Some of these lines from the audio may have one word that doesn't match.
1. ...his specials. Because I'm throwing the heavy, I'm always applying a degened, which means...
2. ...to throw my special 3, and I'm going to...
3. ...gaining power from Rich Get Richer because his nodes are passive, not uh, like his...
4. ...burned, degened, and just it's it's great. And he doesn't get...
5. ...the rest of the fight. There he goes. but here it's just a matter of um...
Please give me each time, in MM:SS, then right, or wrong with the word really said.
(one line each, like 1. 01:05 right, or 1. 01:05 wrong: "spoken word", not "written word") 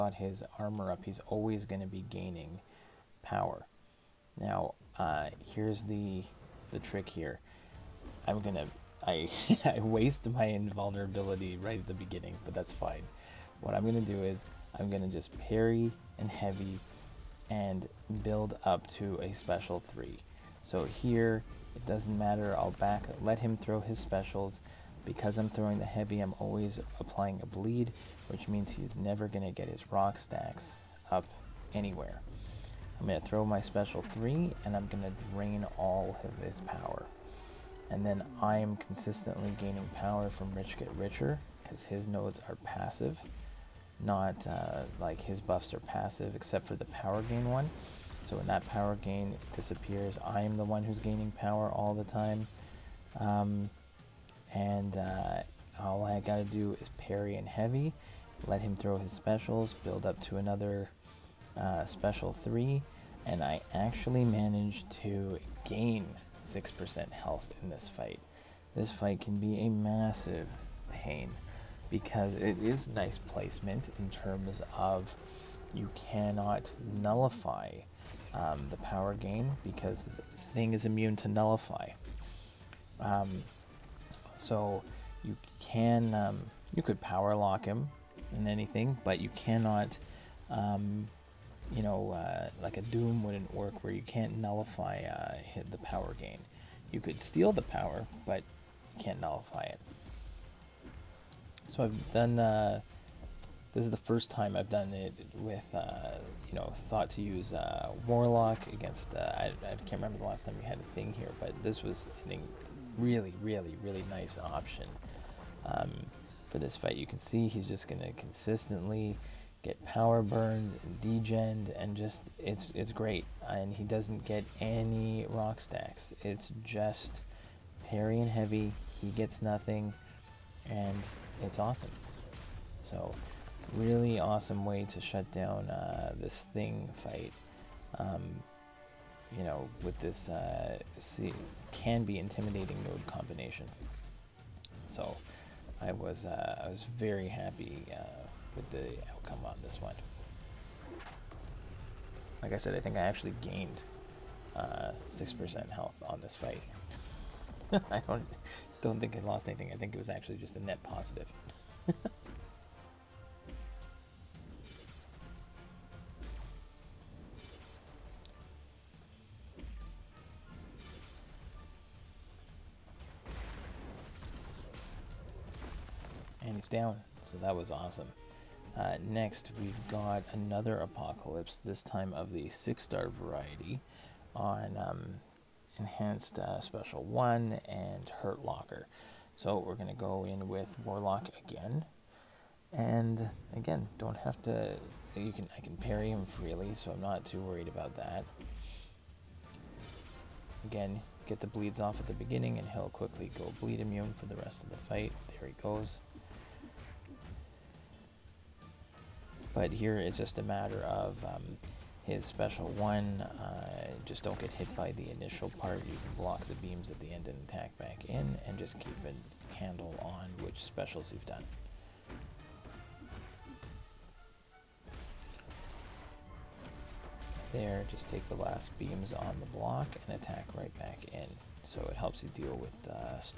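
1. 00:23 wrong: "bleed", not "degened"
2. 00:33 right
3. 00:39 right
4. 02:00 right
5. 03:24 right.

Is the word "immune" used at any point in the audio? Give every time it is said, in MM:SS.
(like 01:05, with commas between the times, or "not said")
01:20, 03:23.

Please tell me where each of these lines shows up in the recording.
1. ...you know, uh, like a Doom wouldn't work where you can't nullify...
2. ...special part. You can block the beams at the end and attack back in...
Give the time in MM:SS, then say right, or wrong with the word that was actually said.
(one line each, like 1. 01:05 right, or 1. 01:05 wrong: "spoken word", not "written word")
1. 01:31 right
2. 03:35 wrong: "initial", not "special".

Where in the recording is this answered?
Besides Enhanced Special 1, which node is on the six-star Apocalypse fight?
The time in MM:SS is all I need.
03:08.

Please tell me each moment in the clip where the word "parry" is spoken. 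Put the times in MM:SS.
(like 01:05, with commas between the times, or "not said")
00:15, 00:56, 02:07, 03:15.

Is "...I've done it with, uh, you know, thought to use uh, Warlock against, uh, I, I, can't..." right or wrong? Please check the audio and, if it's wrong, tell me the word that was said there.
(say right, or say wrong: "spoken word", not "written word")
right.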